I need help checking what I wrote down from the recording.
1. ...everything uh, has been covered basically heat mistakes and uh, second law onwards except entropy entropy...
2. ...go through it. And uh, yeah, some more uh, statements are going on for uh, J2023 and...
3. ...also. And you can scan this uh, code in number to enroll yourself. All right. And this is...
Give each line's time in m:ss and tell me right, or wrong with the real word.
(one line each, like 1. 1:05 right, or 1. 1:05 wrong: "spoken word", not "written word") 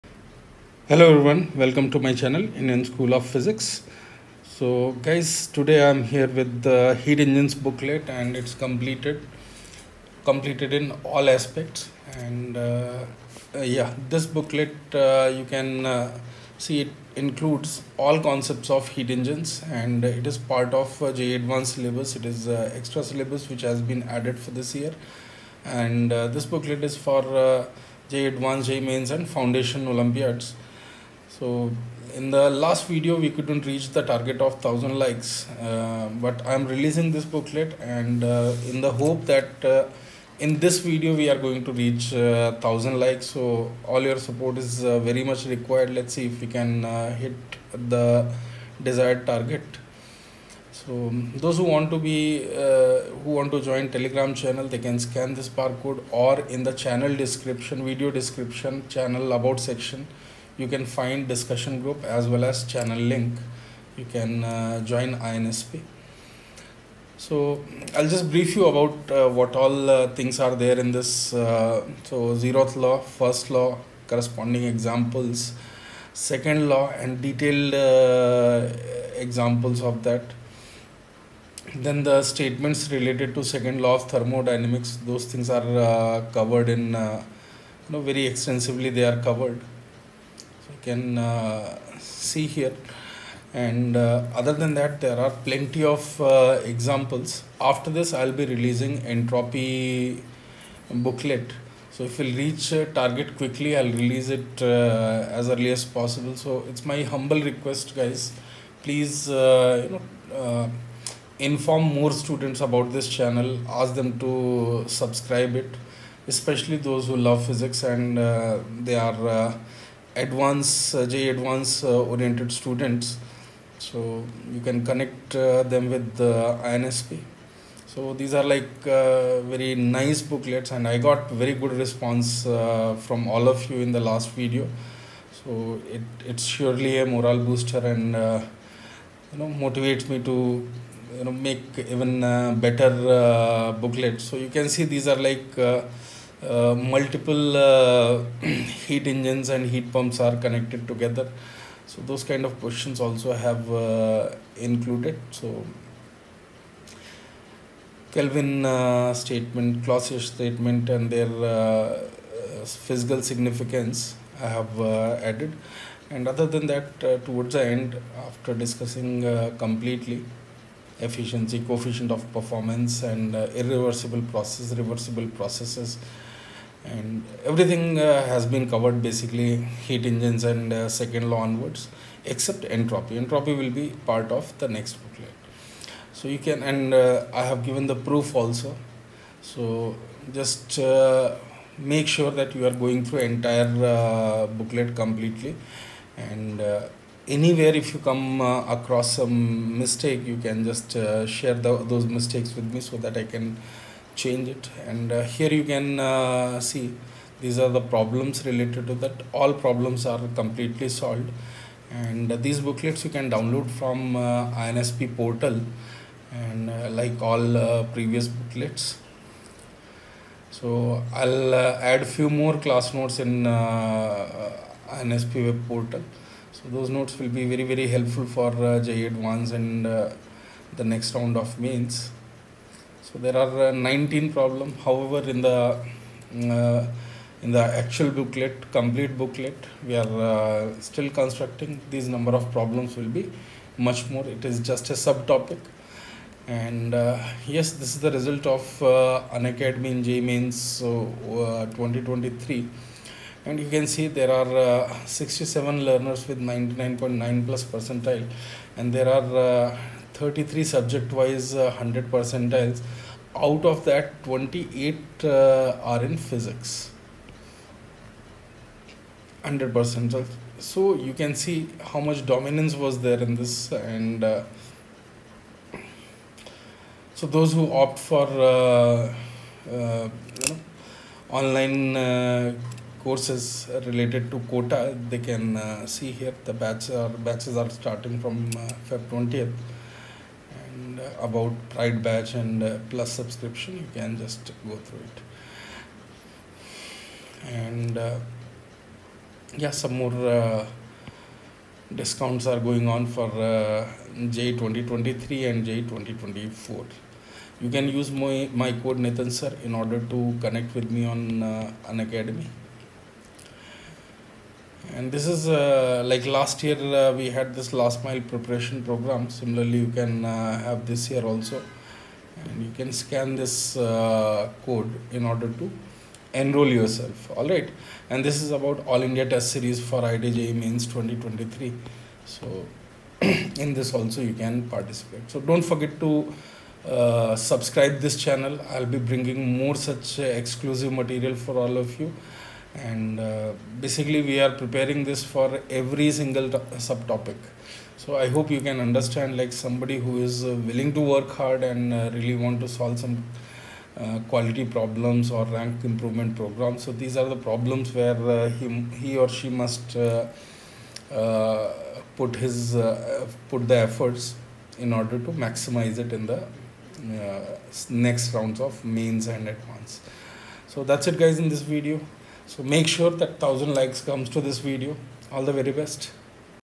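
1. 2:57 wrong: "engines", not "mistakes"
2. 4:54 wrong: "discounts", not "statements"
3. 5:21 wrong: "order", not "number".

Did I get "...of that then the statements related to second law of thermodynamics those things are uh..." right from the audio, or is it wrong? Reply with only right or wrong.
right.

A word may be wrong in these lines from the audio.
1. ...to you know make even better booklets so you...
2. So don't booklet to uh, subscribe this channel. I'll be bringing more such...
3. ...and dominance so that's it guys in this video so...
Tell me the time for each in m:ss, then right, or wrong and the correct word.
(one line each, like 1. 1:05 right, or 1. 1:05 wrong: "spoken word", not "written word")
1. 2:20 right
2. 5:35 wrong: "forget", not "booklet"
3. 6:09 wrong: "advance", not "dominance".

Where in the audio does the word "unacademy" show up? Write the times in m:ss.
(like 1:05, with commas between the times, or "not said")
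4:09, 5:11.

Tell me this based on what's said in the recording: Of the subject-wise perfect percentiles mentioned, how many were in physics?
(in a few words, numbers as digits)
28.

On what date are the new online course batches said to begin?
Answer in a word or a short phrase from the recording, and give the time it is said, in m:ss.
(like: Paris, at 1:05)
Feb 20th, at 4:48.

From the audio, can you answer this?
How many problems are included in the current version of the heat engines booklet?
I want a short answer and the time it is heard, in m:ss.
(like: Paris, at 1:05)
19, at 3:53.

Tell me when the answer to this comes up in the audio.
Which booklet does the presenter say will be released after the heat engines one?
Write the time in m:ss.
1:39.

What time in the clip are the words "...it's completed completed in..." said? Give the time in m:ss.
0:08.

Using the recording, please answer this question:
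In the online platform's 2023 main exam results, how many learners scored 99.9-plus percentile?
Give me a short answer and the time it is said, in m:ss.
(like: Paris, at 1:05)
67, at 4:15.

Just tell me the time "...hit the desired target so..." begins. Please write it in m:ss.
0:47.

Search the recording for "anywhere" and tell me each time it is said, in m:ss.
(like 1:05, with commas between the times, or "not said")
3:17.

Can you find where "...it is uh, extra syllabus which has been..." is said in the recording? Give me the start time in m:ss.
0:22.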